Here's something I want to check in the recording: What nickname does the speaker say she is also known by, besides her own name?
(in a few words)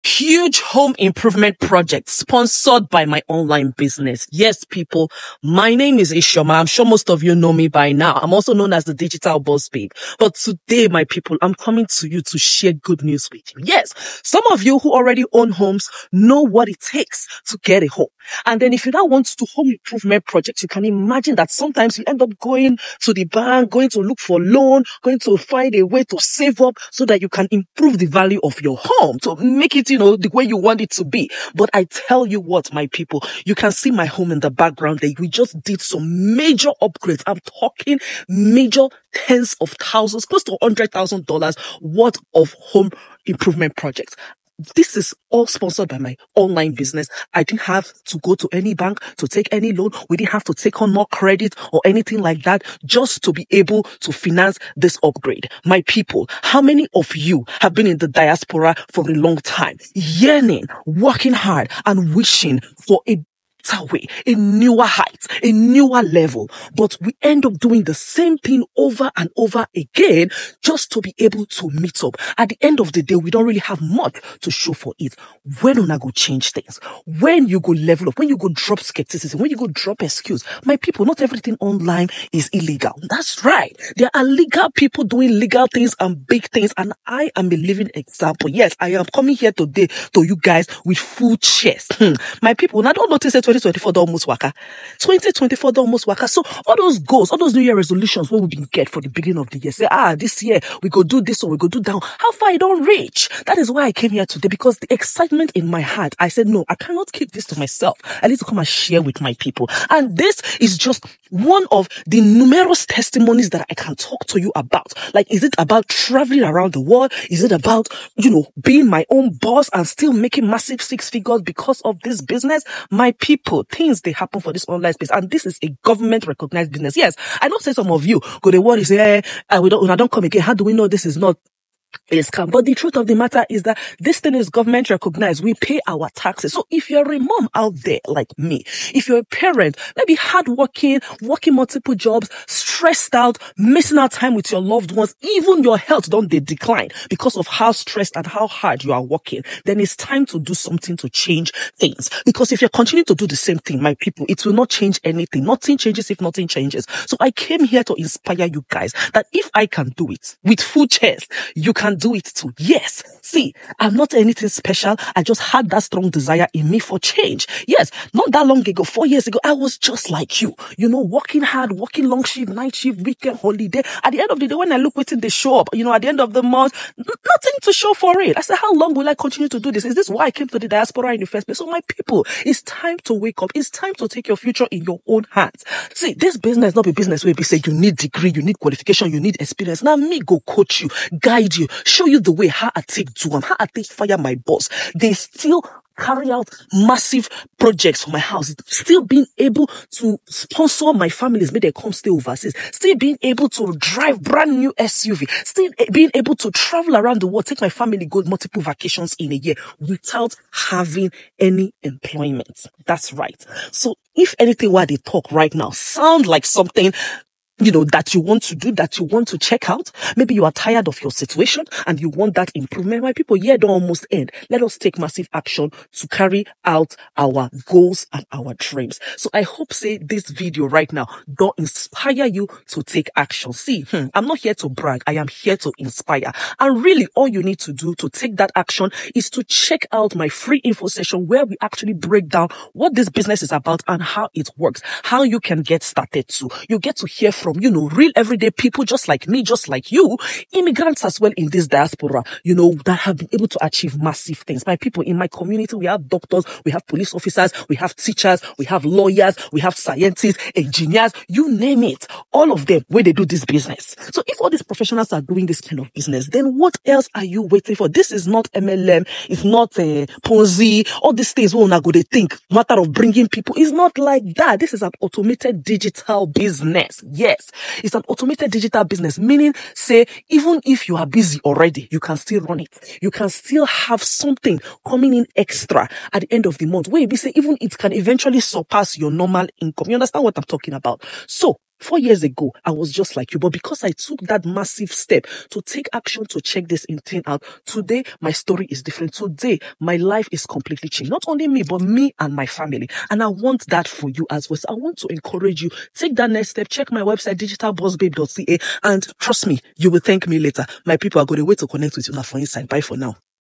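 digital boss babe.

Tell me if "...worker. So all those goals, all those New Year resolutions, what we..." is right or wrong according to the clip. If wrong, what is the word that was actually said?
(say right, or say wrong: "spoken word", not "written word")
right.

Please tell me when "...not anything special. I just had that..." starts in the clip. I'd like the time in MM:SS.
02:43.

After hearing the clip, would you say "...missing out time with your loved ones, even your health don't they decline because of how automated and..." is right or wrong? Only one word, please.
wrong.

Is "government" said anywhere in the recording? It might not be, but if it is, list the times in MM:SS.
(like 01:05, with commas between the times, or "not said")
02:05, 02:14.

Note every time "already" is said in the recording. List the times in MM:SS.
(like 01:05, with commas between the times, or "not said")
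00:14, 04:41.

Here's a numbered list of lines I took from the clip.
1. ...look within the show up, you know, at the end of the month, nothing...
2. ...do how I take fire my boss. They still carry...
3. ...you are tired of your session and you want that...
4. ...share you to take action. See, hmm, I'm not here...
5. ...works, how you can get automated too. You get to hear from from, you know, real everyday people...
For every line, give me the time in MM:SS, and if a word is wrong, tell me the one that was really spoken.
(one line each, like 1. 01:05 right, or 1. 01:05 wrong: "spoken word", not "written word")
1. 02:54 right
2. 03:13 right
3. 03:40 wrong: "situation", not "session"
4. 03:51 wrong: "inspire", not "share"
5. 04:04 wrong: "started", not "automated".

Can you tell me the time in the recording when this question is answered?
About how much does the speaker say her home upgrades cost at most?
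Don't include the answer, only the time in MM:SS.
00:40.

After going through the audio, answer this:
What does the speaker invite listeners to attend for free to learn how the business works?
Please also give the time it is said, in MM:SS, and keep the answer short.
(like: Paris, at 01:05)
info session, at 04:00.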